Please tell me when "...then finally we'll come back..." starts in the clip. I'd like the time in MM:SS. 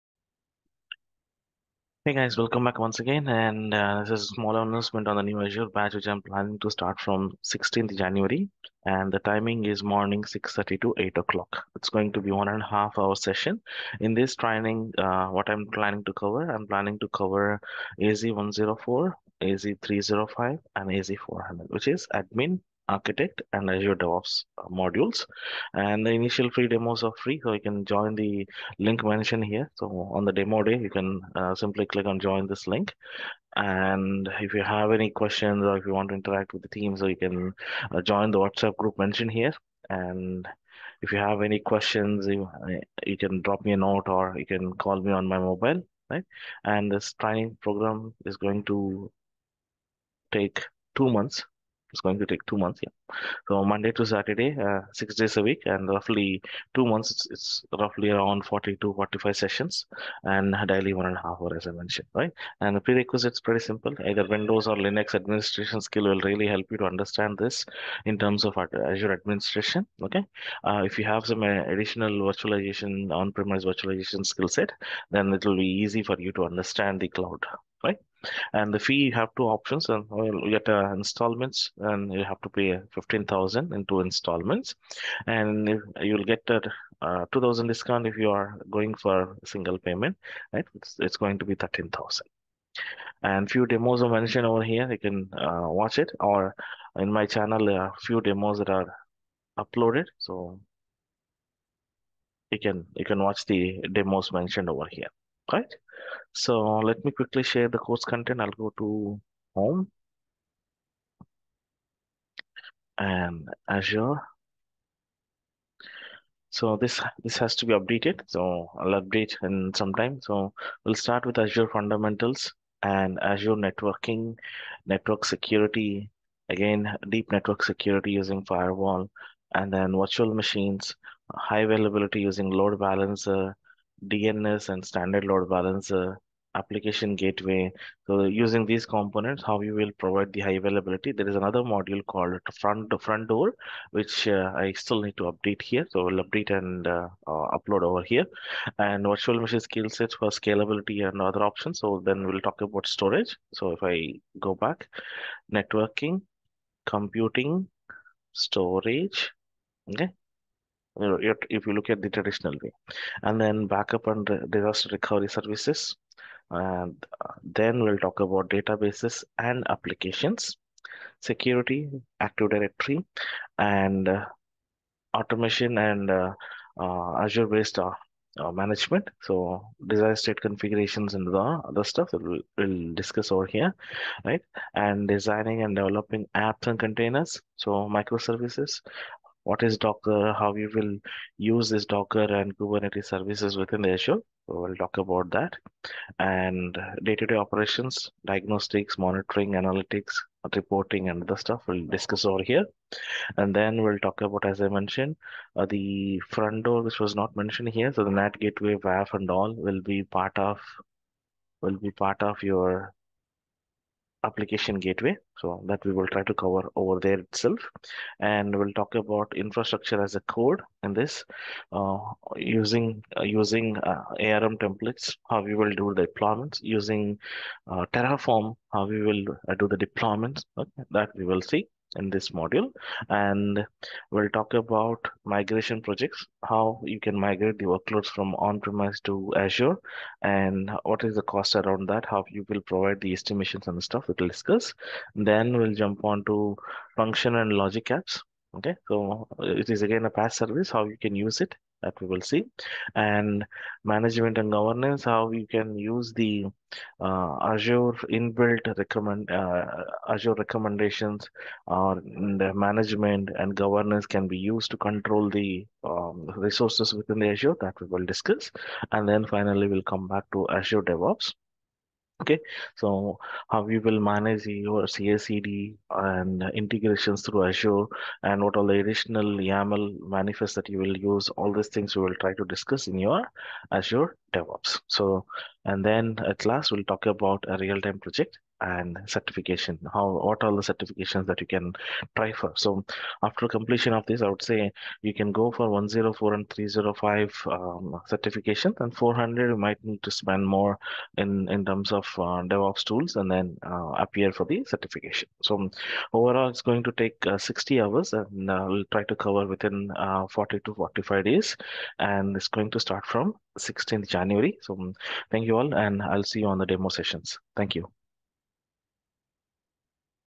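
04:29.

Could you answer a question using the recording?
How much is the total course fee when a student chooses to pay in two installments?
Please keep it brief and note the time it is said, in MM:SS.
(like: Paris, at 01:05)
15000, at 01:22.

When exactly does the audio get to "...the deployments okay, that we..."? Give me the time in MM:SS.
03:49.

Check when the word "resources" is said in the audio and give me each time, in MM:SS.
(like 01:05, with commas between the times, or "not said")
04:26.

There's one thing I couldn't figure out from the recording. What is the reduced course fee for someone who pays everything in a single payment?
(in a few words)
13000.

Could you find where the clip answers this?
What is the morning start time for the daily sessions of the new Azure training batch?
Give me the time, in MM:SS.
00:10.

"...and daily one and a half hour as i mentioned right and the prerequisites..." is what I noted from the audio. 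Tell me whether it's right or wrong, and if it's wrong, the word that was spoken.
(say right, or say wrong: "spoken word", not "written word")
right.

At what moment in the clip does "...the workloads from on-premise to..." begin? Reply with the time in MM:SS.
03:57.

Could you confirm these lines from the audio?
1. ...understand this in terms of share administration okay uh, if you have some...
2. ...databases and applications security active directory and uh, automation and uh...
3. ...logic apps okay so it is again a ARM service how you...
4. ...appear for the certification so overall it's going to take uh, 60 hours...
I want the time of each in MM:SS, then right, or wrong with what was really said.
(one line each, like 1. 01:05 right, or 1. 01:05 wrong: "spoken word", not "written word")
1. 01:06 wrong: "azure", not "share"
2. 02:48 right
3. 04:07 wrong: "PaaS", not "ARM"
4. 05:04 right.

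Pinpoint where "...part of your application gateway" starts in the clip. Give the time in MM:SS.
03:31.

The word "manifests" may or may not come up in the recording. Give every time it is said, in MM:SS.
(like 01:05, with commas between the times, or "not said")
04:40.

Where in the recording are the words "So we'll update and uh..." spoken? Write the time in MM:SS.
02:25.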